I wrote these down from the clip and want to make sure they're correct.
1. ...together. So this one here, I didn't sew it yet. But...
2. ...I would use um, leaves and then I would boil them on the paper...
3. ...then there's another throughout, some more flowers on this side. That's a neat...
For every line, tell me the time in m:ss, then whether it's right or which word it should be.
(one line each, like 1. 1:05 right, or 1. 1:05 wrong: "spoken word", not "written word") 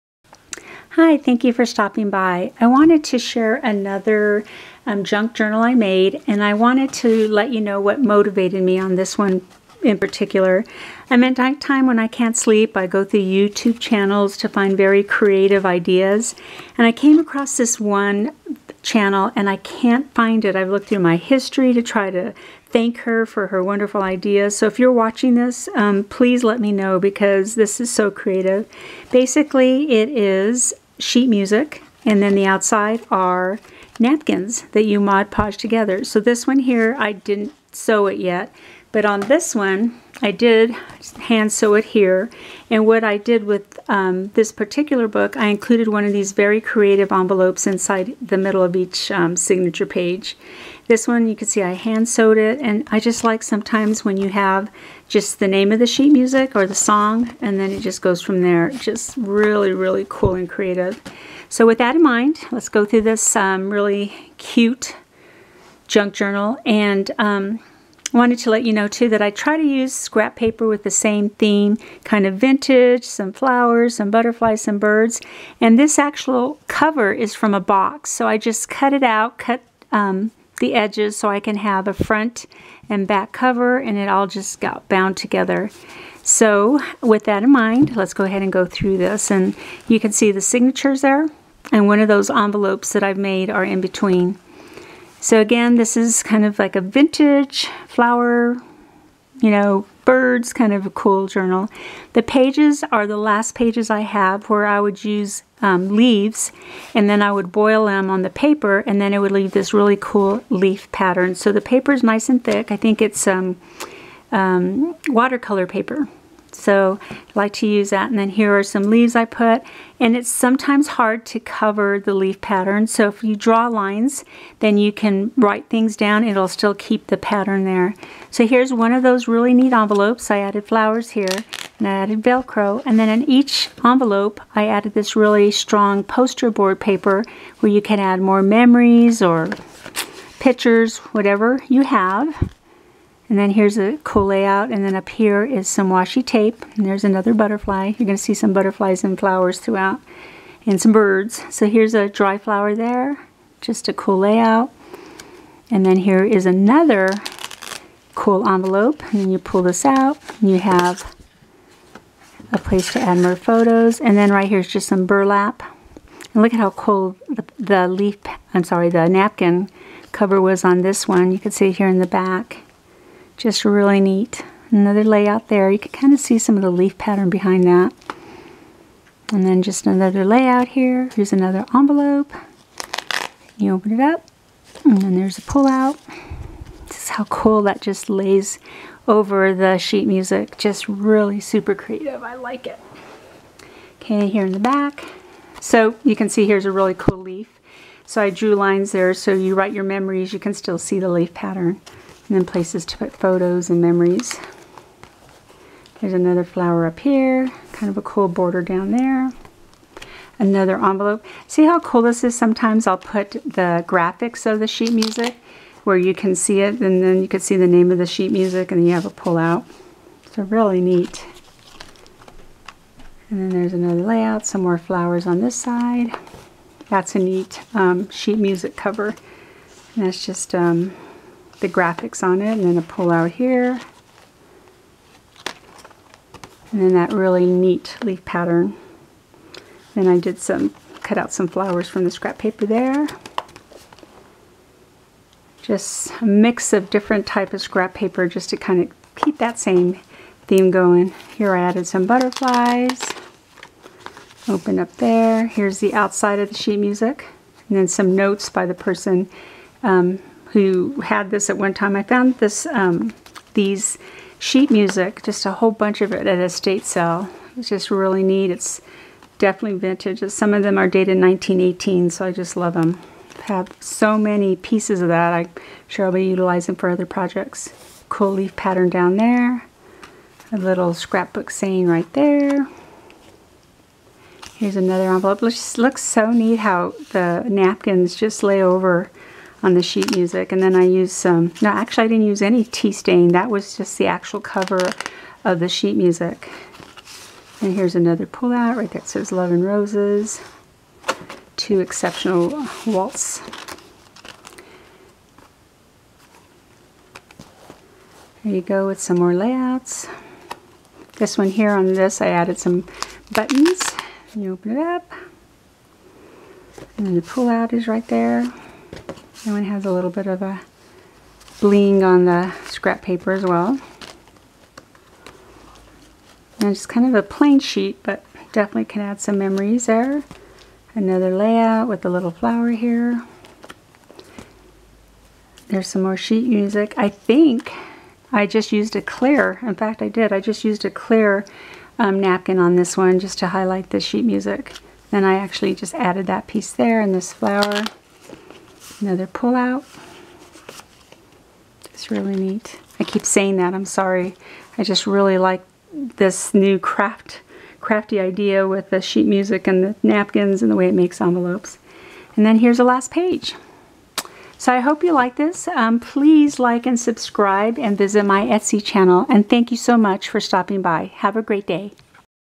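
1. 0:35 right
2. 1:44 right
3. 3:43 wrong: "layout", not "throughout".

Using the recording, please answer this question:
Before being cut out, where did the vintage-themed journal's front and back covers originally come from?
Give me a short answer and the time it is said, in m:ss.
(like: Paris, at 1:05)
A box, at 1:17.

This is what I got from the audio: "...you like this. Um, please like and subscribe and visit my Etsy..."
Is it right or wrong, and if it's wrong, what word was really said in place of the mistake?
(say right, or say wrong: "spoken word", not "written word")
right.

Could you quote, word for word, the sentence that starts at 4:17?
And then some notes by the person um, who had this at one time.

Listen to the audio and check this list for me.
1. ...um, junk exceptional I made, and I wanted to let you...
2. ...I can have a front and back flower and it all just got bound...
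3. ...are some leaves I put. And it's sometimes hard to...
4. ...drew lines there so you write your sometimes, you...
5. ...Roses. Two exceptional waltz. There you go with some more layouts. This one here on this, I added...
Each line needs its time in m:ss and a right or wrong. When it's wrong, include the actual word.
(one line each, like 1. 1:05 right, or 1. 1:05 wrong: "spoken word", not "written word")
1. 0:04 wrong: "journal", not "exceptional"
2. 1:21 wrong: "cover", not "flower"
3. 1:58 right
4. 3:18 wrong: "memories", not "sometimes"
5. 4:59 right.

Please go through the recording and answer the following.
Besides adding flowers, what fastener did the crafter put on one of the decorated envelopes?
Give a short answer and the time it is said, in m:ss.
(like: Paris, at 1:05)
Velcro, at 2:12.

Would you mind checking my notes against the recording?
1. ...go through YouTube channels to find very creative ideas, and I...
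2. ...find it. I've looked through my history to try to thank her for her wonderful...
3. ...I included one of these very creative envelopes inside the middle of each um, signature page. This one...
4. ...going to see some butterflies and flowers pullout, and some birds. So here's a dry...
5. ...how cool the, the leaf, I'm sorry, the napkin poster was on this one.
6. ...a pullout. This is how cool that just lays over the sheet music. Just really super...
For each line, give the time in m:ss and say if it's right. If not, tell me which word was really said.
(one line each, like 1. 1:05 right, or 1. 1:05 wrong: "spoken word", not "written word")
1. 0:12 right
2. 0:20 right
3. 0:45 right
4. 2:28 wrong: "throughout", not "pullout"
5. 2:46 wrong: "cover", not "poster"
6. 3:05 right.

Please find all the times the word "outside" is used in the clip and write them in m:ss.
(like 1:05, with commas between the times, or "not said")
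0:32, 4:15.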